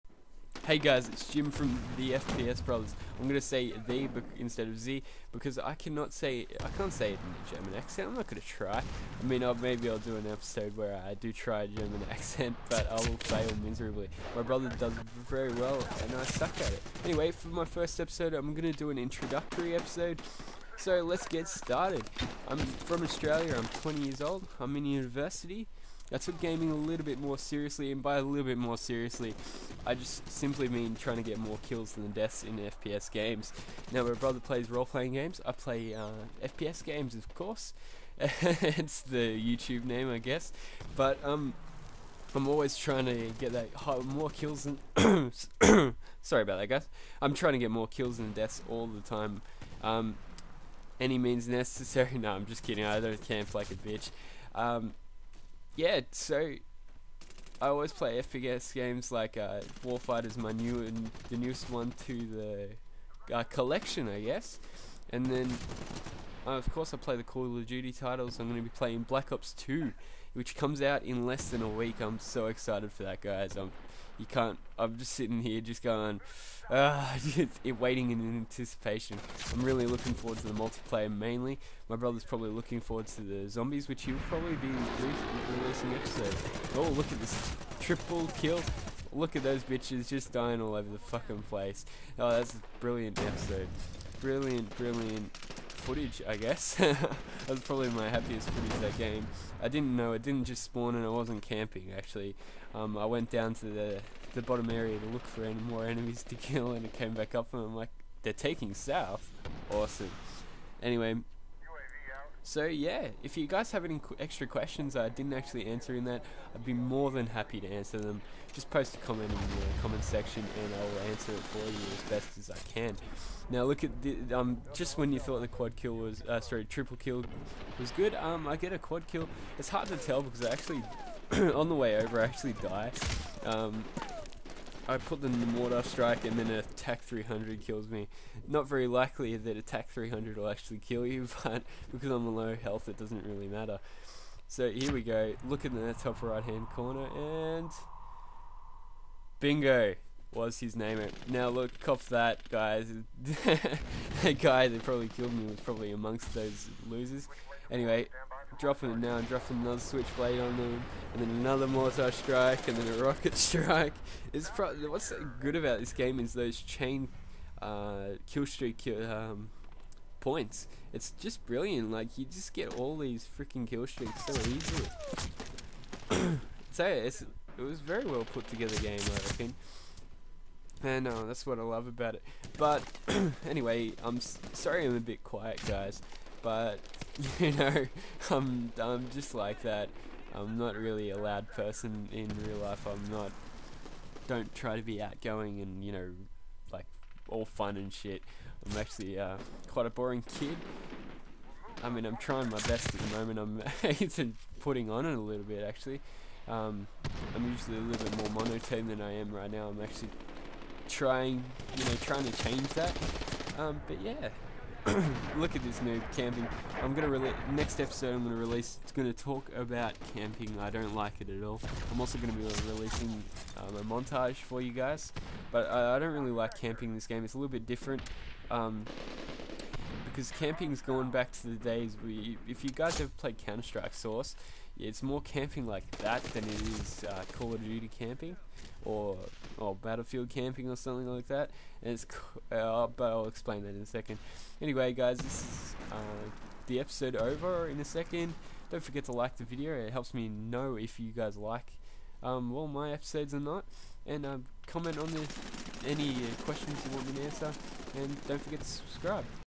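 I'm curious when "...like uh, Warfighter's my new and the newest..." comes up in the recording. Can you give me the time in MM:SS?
00:59.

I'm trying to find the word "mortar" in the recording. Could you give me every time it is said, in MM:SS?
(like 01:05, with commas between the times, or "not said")
02:15, 02:41.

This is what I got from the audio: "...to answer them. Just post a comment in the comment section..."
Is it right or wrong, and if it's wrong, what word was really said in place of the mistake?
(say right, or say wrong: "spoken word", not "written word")
right.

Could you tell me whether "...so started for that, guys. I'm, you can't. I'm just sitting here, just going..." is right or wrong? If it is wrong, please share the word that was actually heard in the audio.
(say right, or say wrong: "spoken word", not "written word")
wrong: "excited", not "started".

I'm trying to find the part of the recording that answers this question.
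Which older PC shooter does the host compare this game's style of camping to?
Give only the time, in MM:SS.
03:53.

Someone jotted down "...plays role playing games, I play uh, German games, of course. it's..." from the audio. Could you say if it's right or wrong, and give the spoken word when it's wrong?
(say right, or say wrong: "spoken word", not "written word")
wrong: "FPS", not "German".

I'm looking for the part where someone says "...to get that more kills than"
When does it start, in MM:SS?
00:43.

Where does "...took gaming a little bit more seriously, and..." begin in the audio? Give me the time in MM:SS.
00:26.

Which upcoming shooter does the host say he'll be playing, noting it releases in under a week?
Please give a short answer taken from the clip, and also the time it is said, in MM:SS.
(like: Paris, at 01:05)
Black Ops 2, at 01:09.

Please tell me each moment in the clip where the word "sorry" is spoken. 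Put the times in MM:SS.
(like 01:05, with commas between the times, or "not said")
00:46, 02:06, 03:04.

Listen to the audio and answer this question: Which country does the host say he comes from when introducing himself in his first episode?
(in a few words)
Australia.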